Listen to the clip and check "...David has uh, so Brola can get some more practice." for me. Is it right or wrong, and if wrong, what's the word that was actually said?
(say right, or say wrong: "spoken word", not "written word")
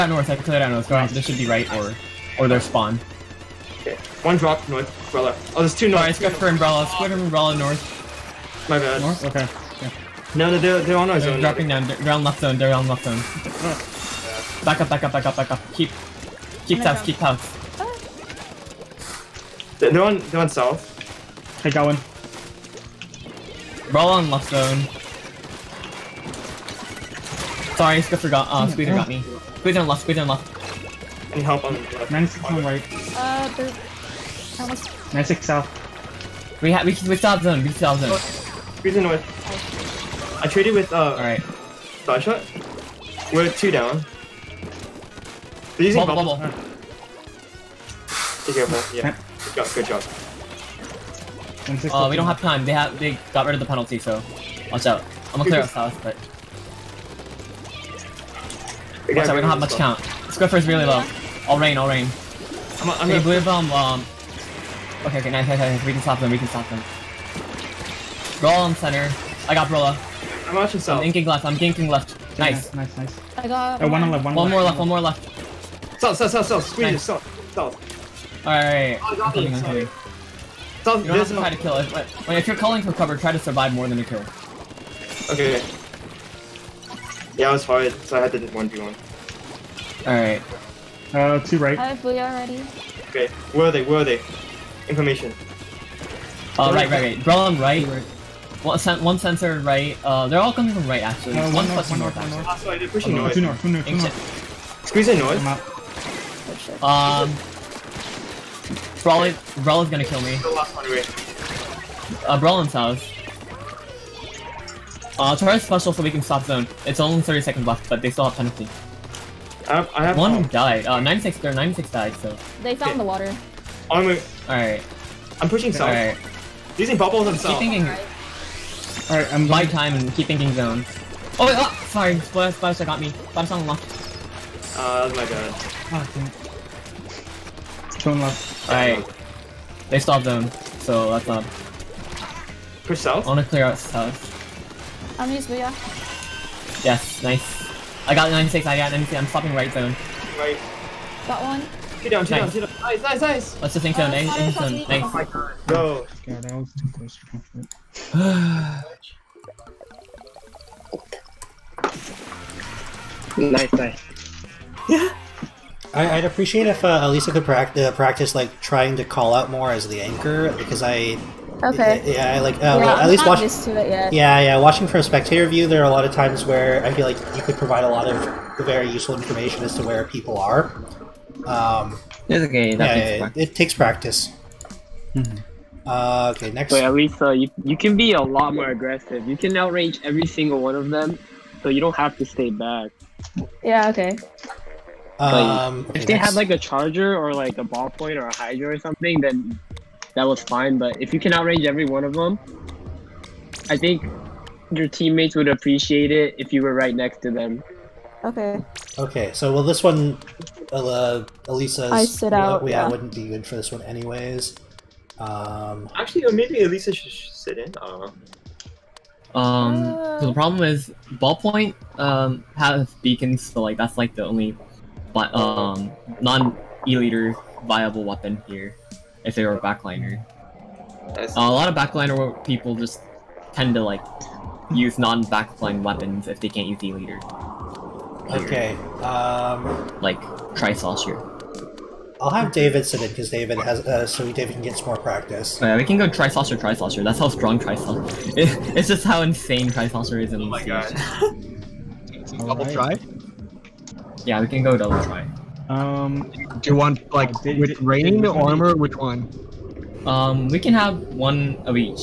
wrong: "David", not "Brola".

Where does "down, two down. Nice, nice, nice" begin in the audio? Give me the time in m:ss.
2:32.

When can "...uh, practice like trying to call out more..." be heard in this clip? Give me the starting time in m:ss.
2:47.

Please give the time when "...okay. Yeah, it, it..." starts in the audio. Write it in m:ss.
3:02.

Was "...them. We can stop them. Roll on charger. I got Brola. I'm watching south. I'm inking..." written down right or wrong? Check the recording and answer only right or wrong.
wrong.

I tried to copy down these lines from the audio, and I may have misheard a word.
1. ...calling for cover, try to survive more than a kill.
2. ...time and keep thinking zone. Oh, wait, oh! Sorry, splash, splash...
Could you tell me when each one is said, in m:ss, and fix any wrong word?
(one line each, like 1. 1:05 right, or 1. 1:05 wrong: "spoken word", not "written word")
1. 1:22 right
2. 2:09 right.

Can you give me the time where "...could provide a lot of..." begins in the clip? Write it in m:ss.
2:57.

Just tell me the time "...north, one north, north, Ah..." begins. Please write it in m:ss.
1:41.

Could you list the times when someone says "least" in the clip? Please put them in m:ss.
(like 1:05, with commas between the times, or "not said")
2:53.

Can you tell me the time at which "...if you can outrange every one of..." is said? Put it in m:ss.
3:21.